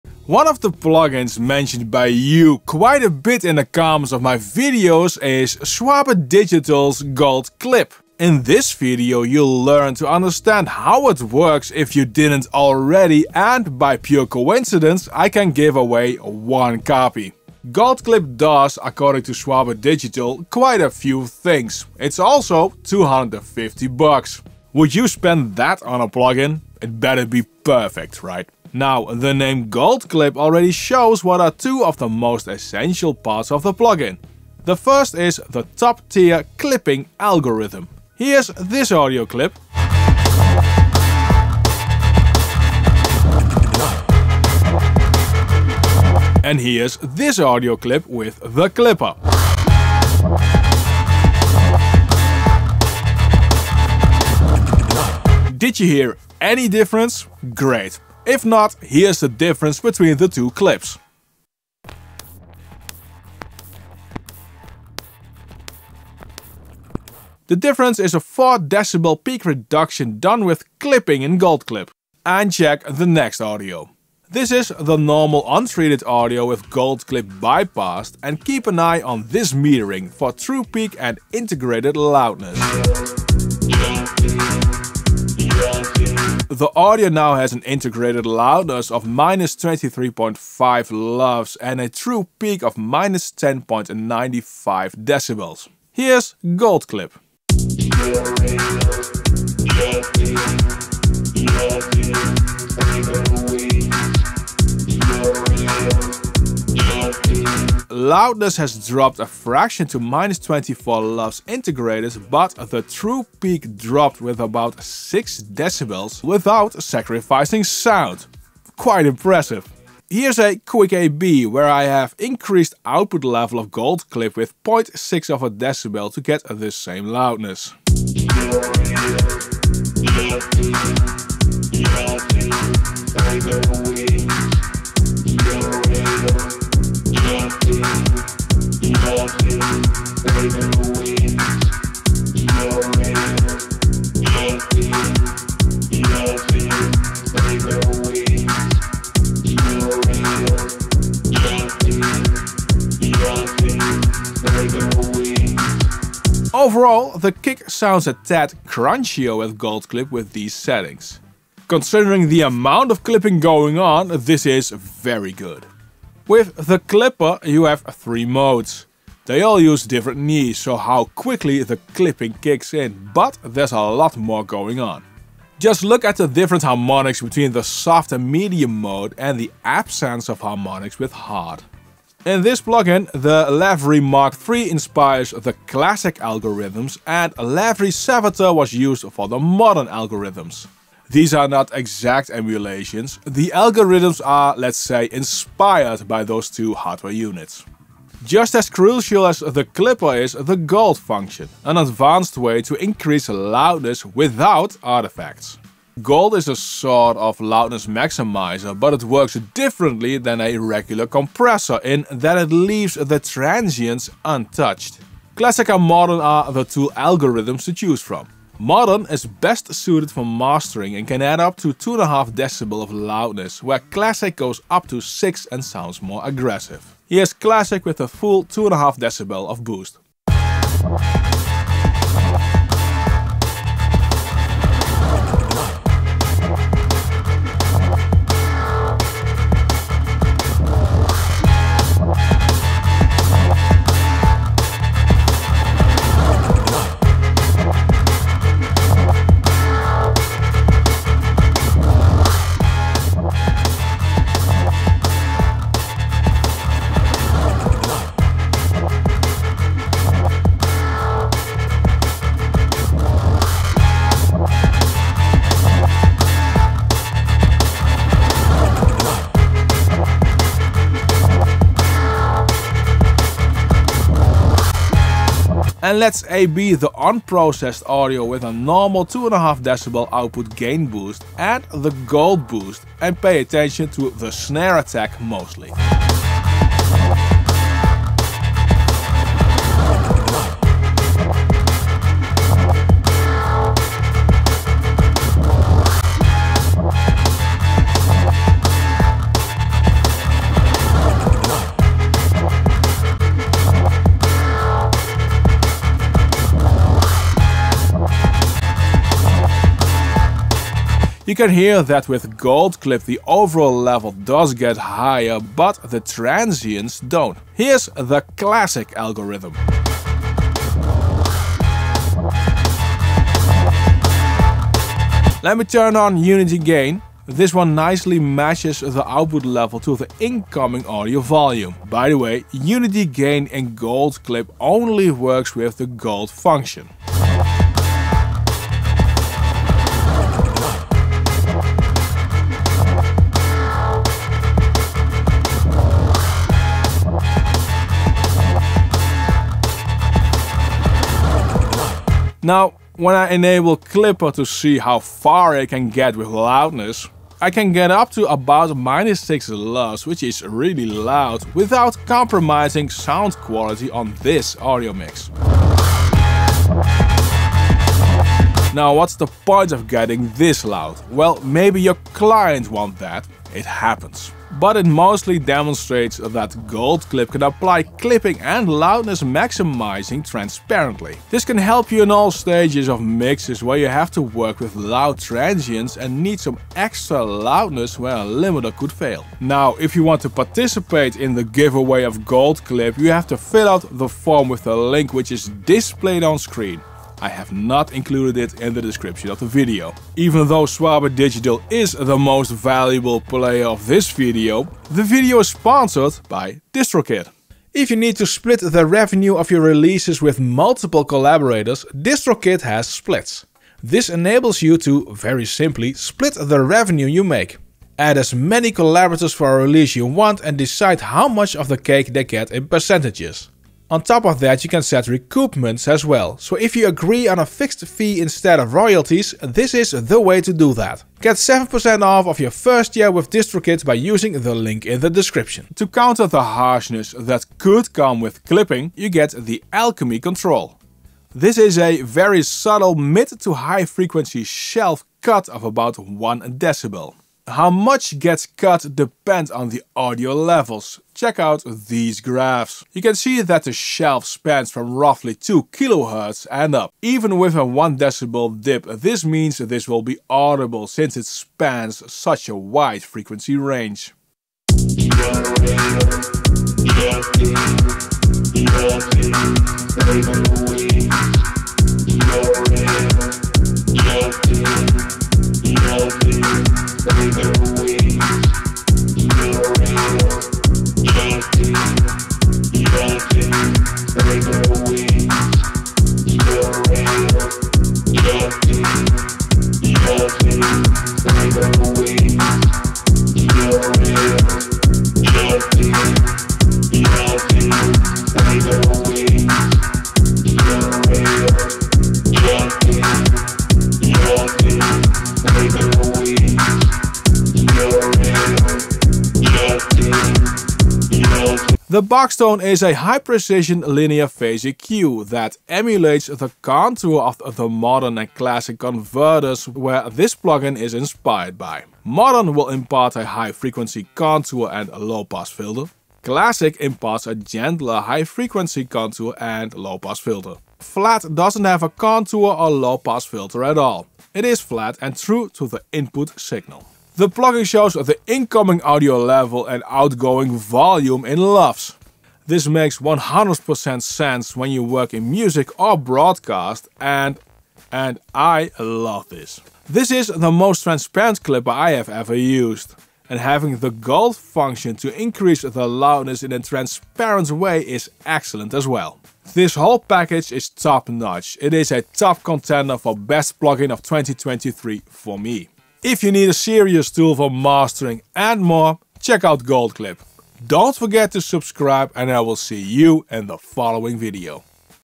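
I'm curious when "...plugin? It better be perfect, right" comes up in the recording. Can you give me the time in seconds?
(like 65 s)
26 s.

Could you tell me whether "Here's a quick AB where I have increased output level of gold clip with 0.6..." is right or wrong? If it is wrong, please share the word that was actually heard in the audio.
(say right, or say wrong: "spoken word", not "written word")
right.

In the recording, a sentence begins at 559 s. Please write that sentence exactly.
This whole package is top notch.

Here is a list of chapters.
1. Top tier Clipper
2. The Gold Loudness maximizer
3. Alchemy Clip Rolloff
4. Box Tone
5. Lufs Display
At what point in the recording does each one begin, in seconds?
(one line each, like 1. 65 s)
1. 35 s
2. 198 s
3. 464 s
4. 511 s
5. 536 s.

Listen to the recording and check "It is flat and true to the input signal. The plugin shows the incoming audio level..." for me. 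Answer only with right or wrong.
right.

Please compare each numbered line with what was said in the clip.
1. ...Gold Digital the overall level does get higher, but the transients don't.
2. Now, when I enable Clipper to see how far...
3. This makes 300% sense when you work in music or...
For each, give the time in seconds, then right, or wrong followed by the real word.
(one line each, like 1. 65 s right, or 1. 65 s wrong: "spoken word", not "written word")
1. 312 s wrong: "Clip", not "Digital"
2. 352 s right
3. 542 s wrong: "100", not "300".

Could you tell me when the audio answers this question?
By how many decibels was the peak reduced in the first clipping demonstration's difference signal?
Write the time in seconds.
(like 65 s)
68 s.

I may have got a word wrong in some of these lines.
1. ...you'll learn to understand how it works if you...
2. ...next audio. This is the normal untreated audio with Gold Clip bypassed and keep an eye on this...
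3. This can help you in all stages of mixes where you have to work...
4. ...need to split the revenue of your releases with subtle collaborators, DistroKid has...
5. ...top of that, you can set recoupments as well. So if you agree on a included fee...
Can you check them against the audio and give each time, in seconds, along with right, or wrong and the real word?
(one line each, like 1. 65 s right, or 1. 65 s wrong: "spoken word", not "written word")
1. 9 s right
2. 73 s right
3. 381 s right
4. 407 s wrong: "multiple", not "subtle"
5. 424 s wrong: "fixed", not "included".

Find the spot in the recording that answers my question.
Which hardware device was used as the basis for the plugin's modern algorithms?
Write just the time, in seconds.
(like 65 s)
187 s.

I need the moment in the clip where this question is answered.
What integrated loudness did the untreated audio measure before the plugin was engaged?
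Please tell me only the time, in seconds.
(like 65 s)
89 s.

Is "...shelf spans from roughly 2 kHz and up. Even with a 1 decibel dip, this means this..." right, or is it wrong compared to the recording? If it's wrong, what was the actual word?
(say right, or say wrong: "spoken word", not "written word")
right.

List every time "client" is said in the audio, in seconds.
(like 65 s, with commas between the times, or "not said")
372 s.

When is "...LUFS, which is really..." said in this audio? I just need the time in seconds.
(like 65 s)
359 s.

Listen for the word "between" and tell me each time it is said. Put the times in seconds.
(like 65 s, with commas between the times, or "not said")
59 s, 177 s.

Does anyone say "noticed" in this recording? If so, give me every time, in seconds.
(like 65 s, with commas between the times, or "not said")
not said.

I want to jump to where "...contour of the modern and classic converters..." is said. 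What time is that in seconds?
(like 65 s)
516 s.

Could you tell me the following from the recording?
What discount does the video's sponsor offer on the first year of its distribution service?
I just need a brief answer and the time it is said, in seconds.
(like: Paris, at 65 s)
7%, at 431 s.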